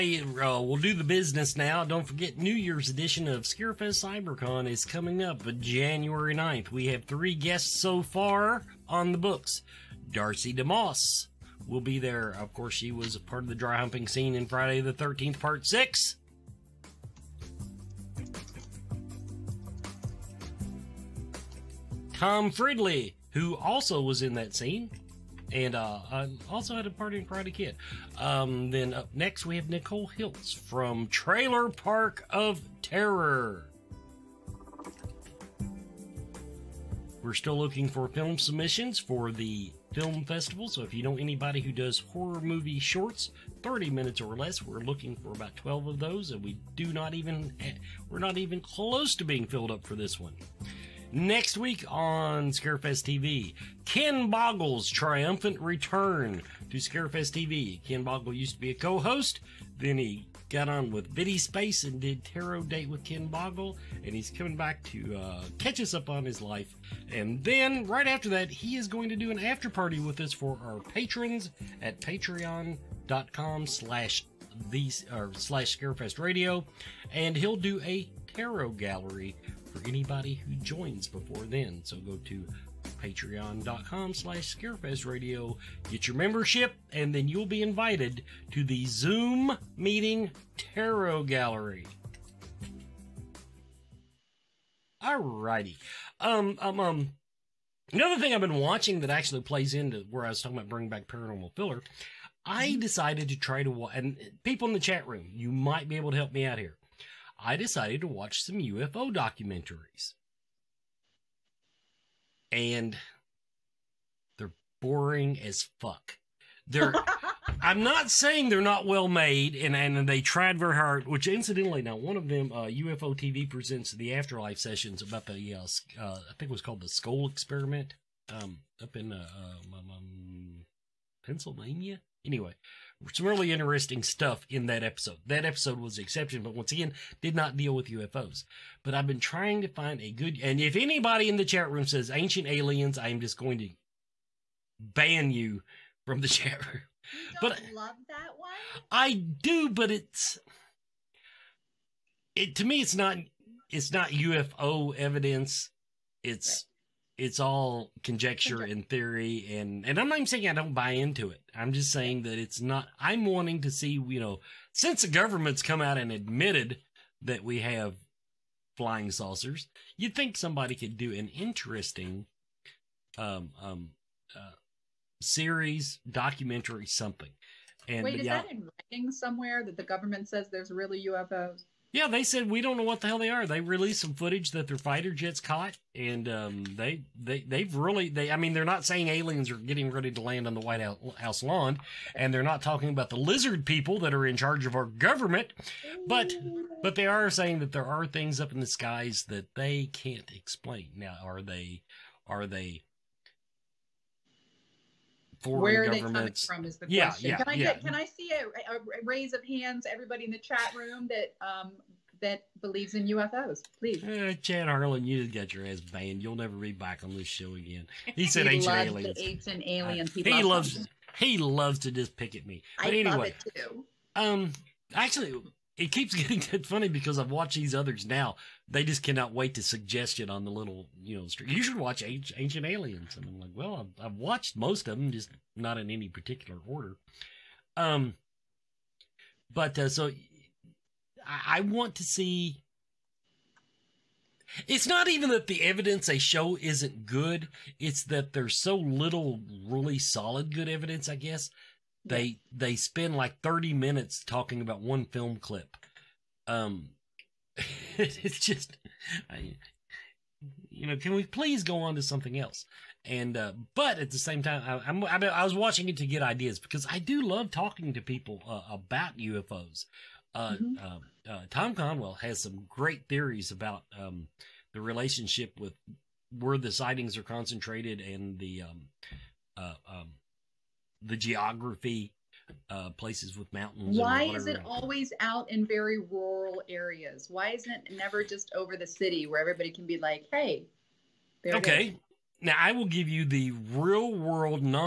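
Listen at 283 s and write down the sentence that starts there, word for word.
Why is it always out in very rural areas?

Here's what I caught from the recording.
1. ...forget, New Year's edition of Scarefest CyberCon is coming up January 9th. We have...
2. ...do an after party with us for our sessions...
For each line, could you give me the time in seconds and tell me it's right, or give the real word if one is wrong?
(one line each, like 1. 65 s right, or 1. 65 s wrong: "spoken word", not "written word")
1. 2 s right
2. 69 s wrong: "patrons", not "sessions".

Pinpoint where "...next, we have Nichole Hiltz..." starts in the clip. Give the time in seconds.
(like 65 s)
29 s.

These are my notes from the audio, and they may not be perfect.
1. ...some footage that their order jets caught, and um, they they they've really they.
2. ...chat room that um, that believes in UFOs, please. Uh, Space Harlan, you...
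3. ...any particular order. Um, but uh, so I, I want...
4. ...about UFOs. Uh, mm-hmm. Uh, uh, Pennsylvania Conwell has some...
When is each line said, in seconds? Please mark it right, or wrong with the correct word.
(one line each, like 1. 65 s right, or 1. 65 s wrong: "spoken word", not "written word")
1. 184 s wrong: "fighter", not "order"
2. 210 s wrong: "Chad", not "Space"
3. 235 s right
4. 268 s wrong: "Tom", not "Pennsylvania".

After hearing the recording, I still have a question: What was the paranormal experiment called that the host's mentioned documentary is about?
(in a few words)
Scole Experiment.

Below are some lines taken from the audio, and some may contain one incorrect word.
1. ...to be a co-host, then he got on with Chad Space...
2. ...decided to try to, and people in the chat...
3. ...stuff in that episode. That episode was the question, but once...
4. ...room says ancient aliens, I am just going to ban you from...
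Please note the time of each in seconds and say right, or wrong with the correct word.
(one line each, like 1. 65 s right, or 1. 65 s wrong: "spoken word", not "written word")
1. 58 s wrong: "Viddy", not "Chad"
2. 102 s right
3. 134 s wrong: "exception", not "question"
4. 141 s right.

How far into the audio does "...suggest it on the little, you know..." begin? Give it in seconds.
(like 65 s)
229 s.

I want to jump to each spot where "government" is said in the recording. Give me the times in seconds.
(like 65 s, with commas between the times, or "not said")
165 s, 179 s, 194 s, 205 s.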